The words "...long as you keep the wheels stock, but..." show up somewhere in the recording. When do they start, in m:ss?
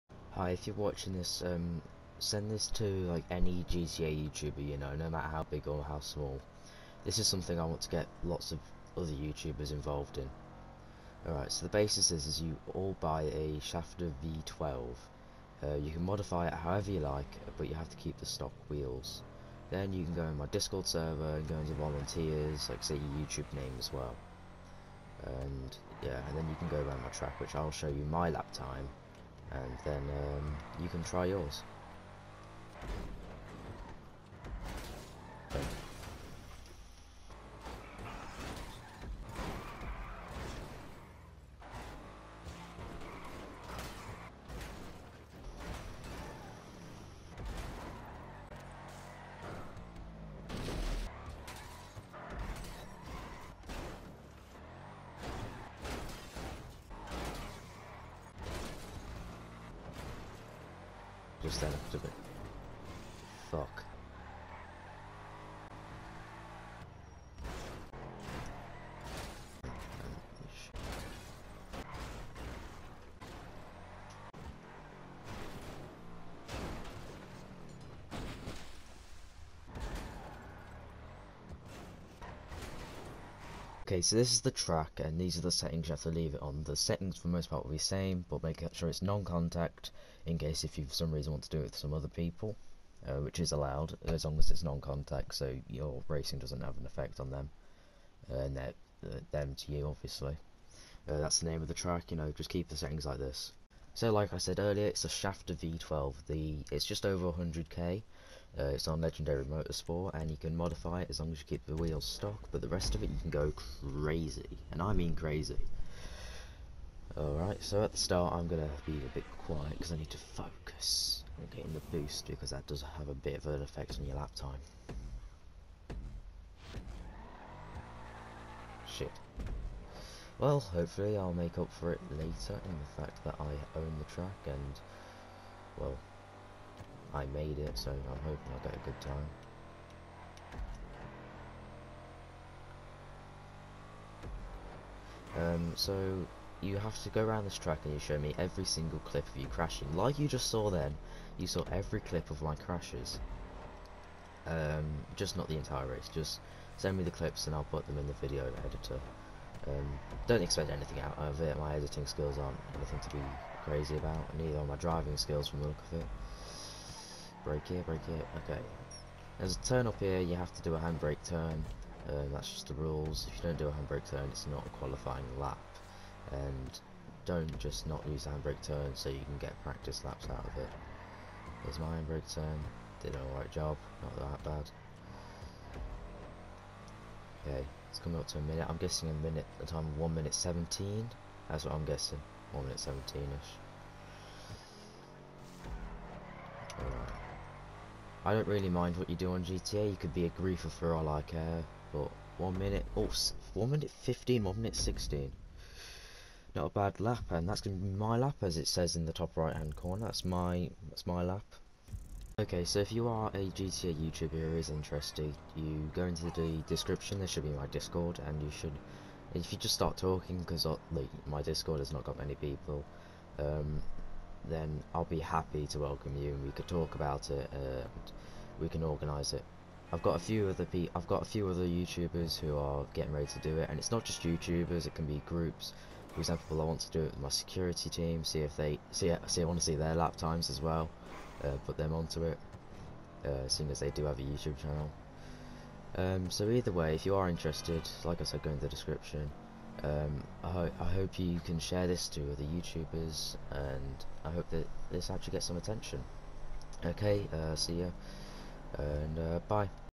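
1:51.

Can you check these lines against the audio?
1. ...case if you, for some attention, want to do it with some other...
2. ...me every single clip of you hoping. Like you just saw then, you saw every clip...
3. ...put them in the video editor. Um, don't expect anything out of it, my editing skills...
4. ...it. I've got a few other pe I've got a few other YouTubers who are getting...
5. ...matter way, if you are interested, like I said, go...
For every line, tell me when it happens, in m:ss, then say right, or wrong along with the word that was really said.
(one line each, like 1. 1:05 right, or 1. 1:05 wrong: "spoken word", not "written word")
1. 1:30 wrong: "reason", not "attention"
2. 2:28 wrong: "crashing", not "hoping"
3. 2:37 right
4. 3:49 right
5. 4:06 wrong: "either", not "matter".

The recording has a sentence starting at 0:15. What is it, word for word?
Uh, you can modify it however you like, but you have to keep the stock wheels.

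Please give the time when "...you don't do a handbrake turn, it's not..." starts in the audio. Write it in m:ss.
2:53.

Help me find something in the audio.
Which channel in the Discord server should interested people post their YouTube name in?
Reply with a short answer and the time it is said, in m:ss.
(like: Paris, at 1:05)
volunteers, at 0:21.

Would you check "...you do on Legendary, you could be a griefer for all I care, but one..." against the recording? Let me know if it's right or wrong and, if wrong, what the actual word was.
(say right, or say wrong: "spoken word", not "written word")
wrong: "GTA", not "Legendary".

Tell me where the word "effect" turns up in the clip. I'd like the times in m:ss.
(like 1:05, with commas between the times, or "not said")
1:36, 2:03.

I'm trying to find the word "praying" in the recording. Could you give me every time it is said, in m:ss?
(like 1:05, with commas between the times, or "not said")
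not said.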